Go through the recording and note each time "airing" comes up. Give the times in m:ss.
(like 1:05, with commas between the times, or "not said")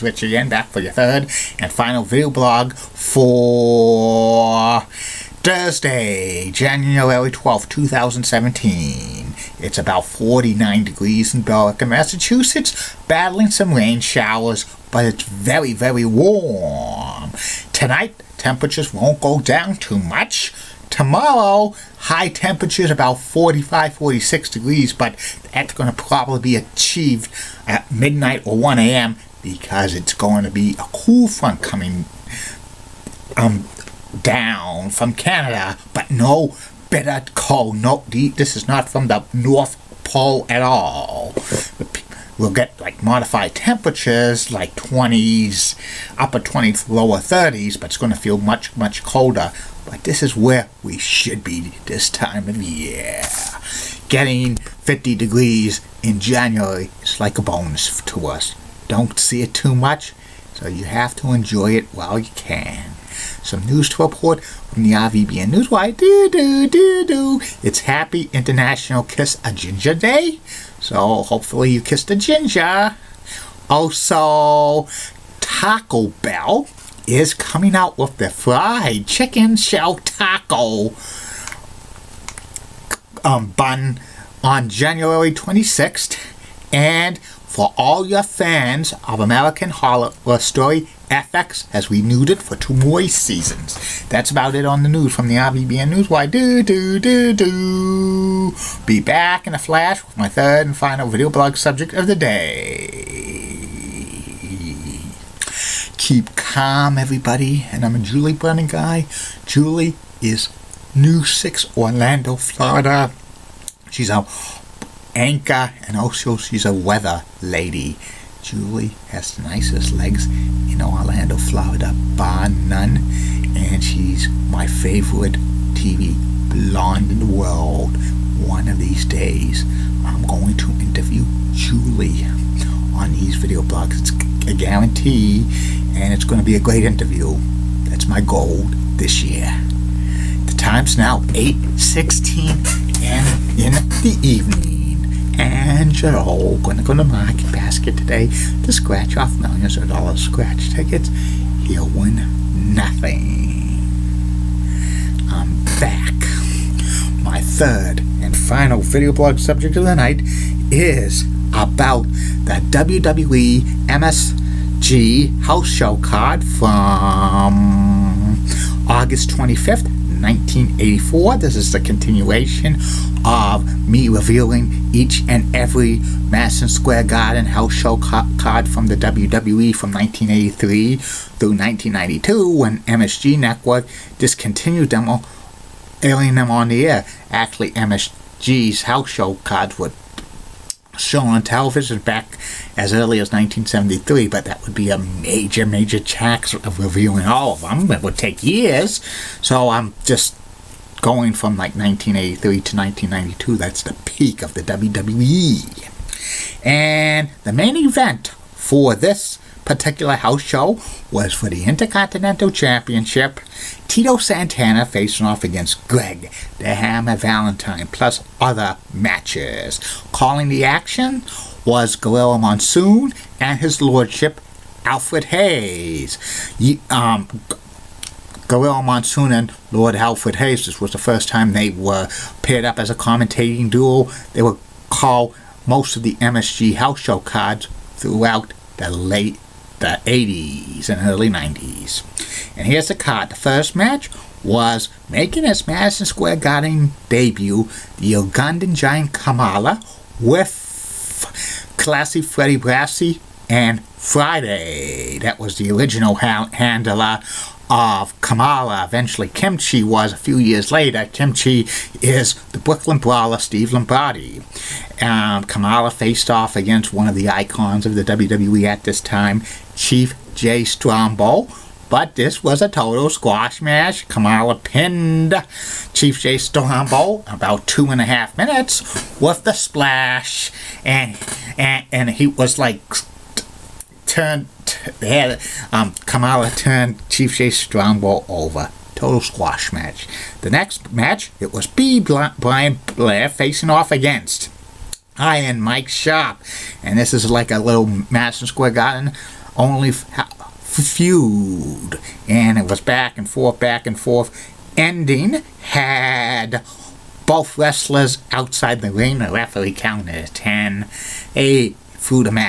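3:06.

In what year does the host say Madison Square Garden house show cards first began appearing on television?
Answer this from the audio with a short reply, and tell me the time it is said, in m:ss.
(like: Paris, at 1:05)
1973, at 3:13.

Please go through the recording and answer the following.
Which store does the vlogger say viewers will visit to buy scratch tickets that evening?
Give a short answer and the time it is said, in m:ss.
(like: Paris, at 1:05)
Market Basket, at 2:27.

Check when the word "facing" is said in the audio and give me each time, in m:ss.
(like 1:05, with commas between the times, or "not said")
3:34, 4:53.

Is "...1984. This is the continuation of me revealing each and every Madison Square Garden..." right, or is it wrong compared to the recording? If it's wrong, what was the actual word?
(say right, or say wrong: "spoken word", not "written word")
right.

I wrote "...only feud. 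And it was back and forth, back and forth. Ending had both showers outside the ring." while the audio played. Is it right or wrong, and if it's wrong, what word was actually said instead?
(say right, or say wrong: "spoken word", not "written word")
wrong: "wrestlers", not "showers".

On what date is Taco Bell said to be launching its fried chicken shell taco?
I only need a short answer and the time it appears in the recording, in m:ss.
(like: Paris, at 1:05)
January 26th, at 1:24.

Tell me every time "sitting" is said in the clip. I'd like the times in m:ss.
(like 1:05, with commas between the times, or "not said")
not said.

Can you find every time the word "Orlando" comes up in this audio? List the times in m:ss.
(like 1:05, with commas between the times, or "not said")
1:51, 2:00.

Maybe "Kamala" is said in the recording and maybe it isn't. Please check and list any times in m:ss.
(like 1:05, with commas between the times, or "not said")
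4:09, 4:18, 4:25, 4:34, 4:46.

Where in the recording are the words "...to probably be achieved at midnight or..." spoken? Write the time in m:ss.
0:25.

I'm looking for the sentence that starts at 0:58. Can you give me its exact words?
Don't see it too much, so you have to enjoy it while you can.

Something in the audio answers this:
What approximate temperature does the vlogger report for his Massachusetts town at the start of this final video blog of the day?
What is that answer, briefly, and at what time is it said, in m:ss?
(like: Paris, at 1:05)
49 degrees, at 0:10.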